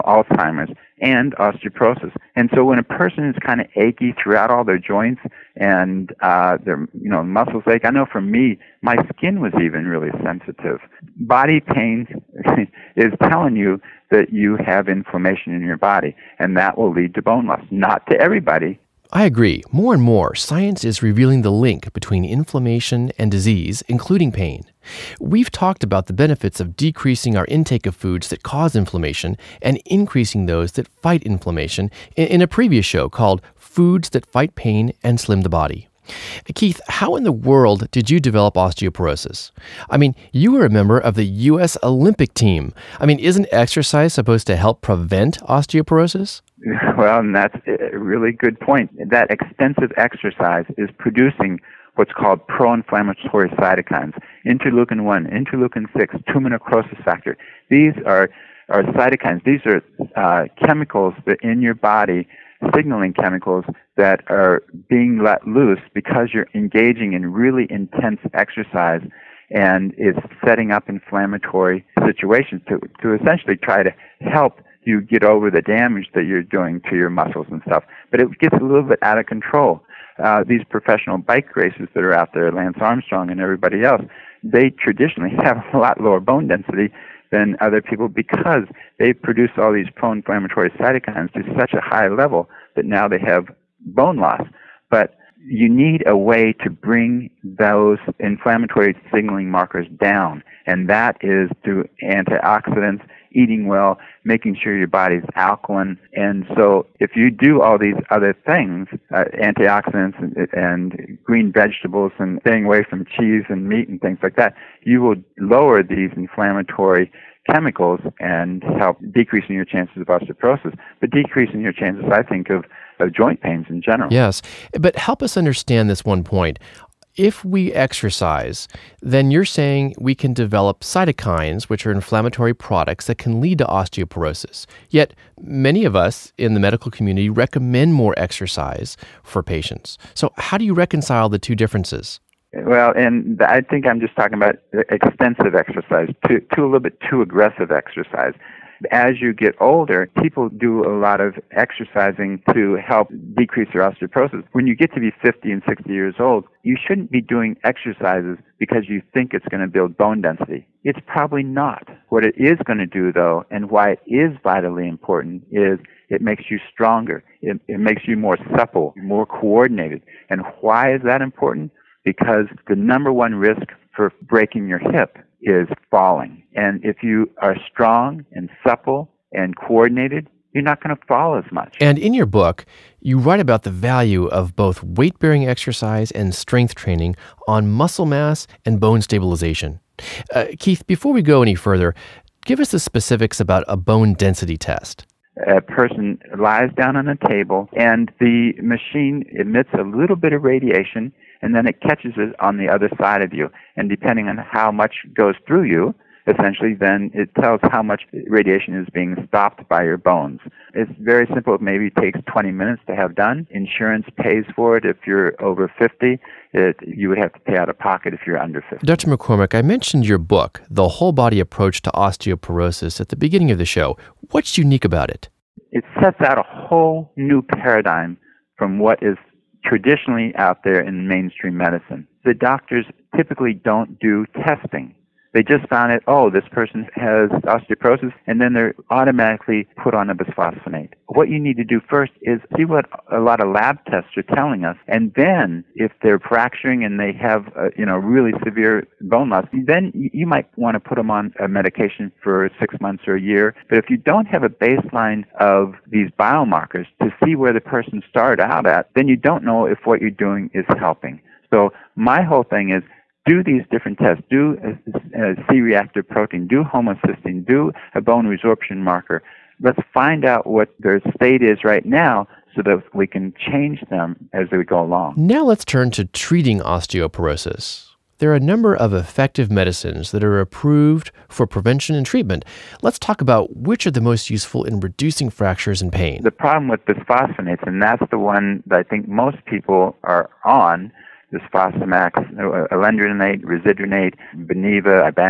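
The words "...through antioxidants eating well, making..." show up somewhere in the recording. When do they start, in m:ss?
1:41.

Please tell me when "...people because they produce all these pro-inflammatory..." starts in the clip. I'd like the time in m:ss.
1:27.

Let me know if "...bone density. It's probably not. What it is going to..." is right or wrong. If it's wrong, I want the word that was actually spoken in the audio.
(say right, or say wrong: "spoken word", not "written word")
right.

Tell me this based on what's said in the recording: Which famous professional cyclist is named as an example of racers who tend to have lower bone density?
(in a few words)
Lance Armstrong.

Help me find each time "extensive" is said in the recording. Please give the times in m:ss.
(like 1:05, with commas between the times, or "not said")
0:49, 2:24.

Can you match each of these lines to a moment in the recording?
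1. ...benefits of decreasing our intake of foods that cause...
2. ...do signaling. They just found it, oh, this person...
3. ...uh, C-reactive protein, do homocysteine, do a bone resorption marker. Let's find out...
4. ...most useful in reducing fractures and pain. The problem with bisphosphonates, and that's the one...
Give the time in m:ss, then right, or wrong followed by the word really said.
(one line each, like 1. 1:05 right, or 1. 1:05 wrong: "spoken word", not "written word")
1. 0:26 right
2. 3:53 wrong: "testing", not "signaling"
3. 4:25 right
4. 4:44 right.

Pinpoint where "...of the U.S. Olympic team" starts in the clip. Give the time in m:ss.
0:40.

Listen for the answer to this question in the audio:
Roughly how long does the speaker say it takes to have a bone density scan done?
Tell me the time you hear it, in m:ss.
3:32.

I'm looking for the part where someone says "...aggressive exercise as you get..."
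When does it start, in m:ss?
2:27.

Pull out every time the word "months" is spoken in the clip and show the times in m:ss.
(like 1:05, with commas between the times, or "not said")
4:12.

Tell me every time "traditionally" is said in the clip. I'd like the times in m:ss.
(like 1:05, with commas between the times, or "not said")
1:24, 3:49.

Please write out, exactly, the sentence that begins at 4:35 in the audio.
Now let's turn to treating osteoporosis.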